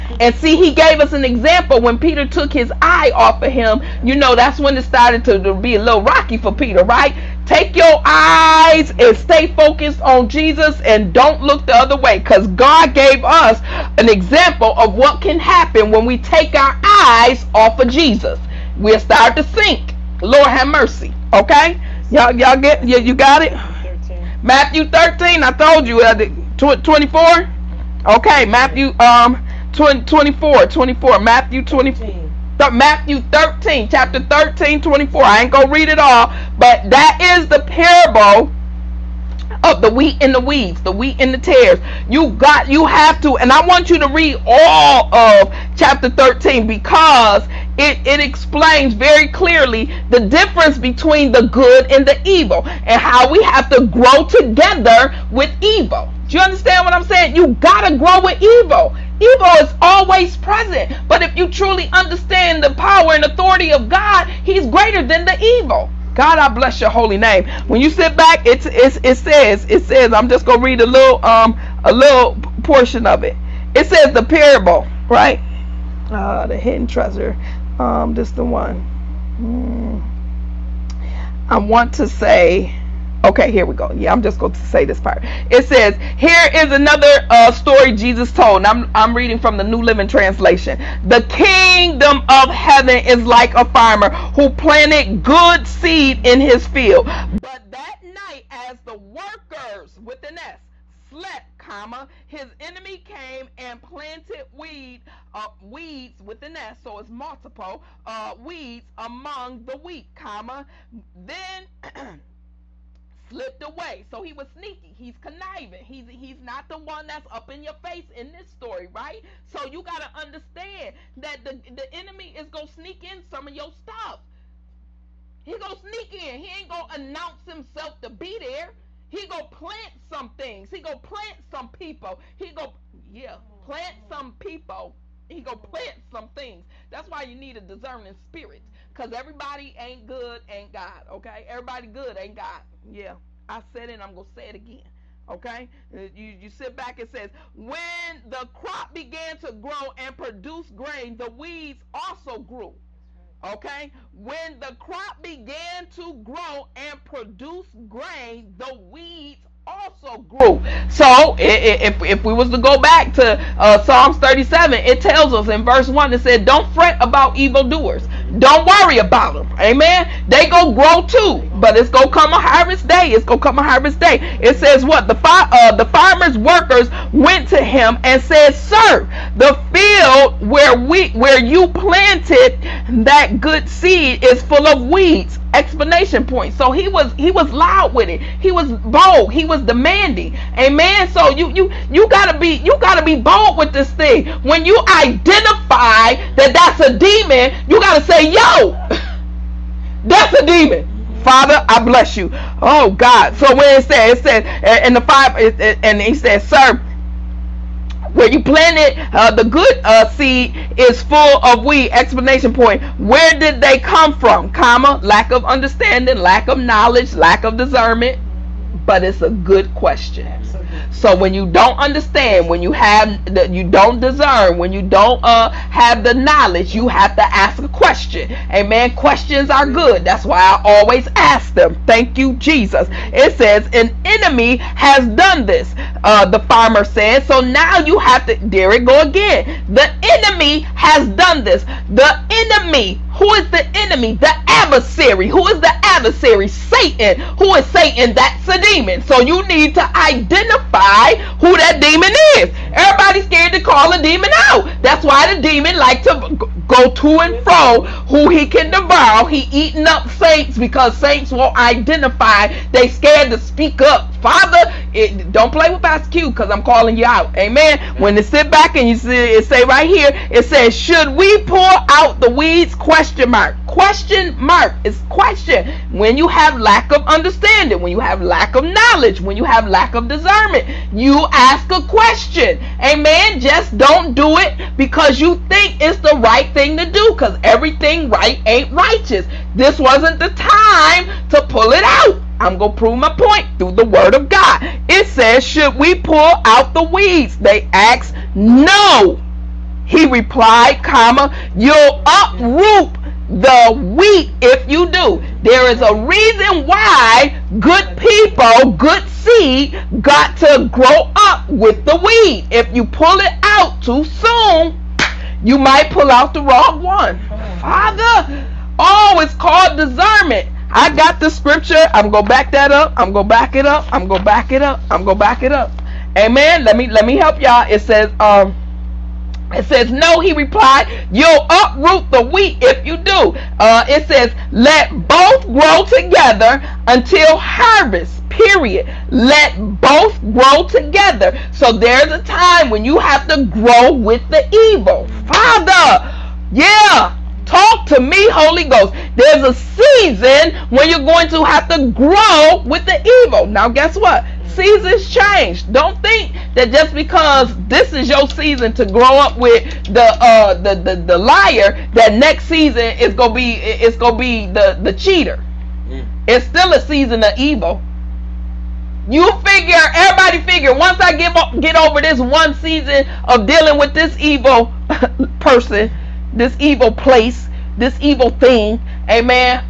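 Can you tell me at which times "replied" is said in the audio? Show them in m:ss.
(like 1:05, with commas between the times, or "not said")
5:00, 5:30.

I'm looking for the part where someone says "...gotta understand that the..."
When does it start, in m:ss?
1:59.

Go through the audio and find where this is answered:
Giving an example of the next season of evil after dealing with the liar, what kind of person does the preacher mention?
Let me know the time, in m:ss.
6:04.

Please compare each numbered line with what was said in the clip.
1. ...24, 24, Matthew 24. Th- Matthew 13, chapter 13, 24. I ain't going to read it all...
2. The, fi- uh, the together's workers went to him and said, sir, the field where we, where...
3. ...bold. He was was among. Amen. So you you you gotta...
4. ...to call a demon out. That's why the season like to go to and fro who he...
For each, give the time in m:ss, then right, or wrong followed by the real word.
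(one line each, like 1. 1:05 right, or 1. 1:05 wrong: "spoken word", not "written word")
1. 0:29 right
2. 2:55 wrong: "farmer", not "together"
3. 3:08 wrong: "demanding", not "among"
4. 4:13 wrong: "demon", not "season".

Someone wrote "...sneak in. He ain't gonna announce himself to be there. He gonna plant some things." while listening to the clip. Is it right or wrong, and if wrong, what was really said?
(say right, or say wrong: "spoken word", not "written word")
right.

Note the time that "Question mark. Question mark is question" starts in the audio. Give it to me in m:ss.
4:32.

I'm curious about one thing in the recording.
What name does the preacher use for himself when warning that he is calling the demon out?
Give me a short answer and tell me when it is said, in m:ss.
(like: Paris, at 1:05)
Pastor Q, at 4:25.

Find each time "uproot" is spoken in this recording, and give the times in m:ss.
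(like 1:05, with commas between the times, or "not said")
5:02, 5:31.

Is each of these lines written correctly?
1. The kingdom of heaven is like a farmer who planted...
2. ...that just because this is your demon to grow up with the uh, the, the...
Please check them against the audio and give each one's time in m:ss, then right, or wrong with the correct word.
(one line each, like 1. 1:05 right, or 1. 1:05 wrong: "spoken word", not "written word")
1. 1:31 right
2. 5:56 wrong: "season", not "demon".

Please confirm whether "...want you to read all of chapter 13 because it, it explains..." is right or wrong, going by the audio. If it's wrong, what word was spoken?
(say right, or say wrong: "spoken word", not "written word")
right.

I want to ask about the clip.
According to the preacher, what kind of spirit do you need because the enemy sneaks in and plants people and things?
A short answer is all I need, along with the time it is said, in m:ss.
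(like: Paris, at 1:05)
discerning spirit, at 2:17.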